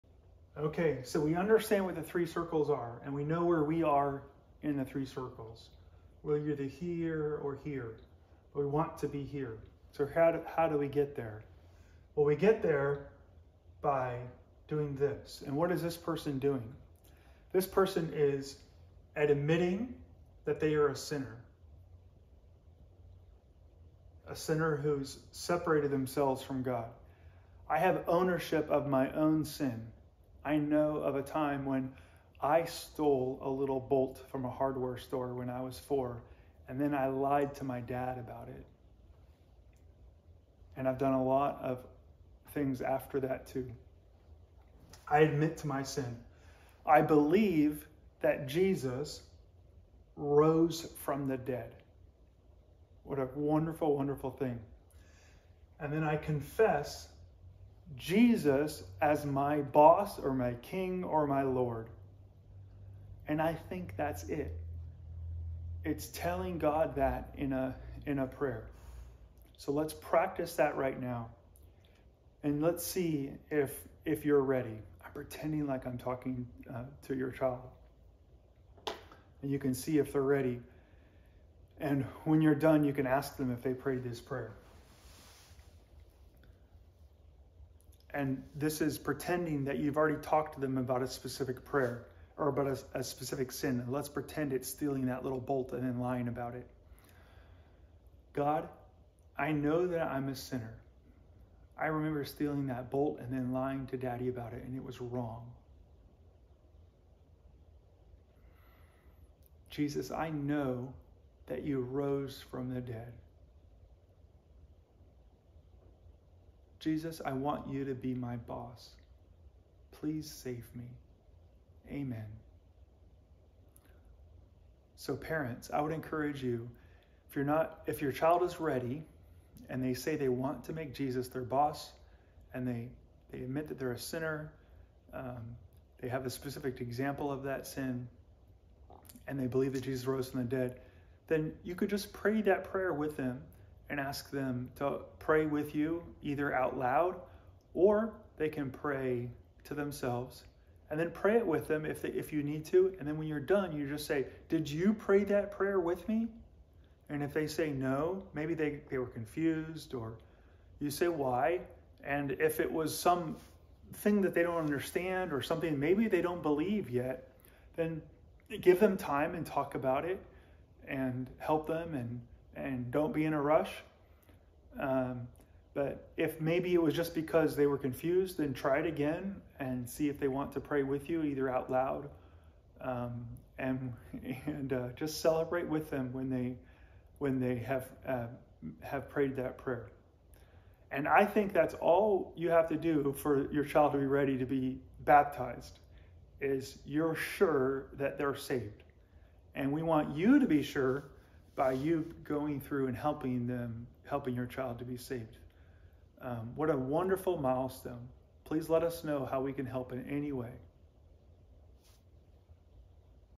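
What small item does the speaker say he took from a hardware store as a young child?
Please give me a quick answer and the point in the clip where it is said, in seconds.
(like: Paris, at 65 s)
A little bolt, at 33 s.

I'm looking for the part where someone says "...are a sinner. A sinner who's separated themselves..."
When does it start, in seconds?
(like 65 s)
20 s.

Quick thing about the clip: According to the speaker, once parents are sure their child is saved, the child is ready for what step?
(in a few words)
Baptized.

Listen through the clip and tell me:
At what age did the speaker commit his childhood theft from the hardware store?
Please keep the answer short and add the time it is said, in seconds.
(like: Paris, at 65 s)
4, at 35 s.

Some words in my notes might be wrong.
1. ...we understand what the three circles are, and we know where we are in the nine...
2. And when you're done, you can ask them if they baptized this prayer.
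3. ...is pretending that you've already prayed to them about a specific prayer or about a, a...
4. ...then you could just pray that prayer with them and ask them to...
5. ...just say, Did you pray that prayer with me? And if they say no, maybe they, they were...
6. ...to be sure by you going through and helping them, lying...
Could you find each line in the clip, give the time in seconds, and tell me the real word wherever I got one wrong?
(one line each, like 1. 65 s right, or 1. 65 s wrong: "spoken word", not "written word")
1. 1 s wrong: "three", not "nine"
2. 81 s wrong: "prayed", not "baptized"
3. 88 s wrong: "talked", not "prayed"
4. 141 s right
5. 153 s right
6. 200 s wrong: "helping", not "lying".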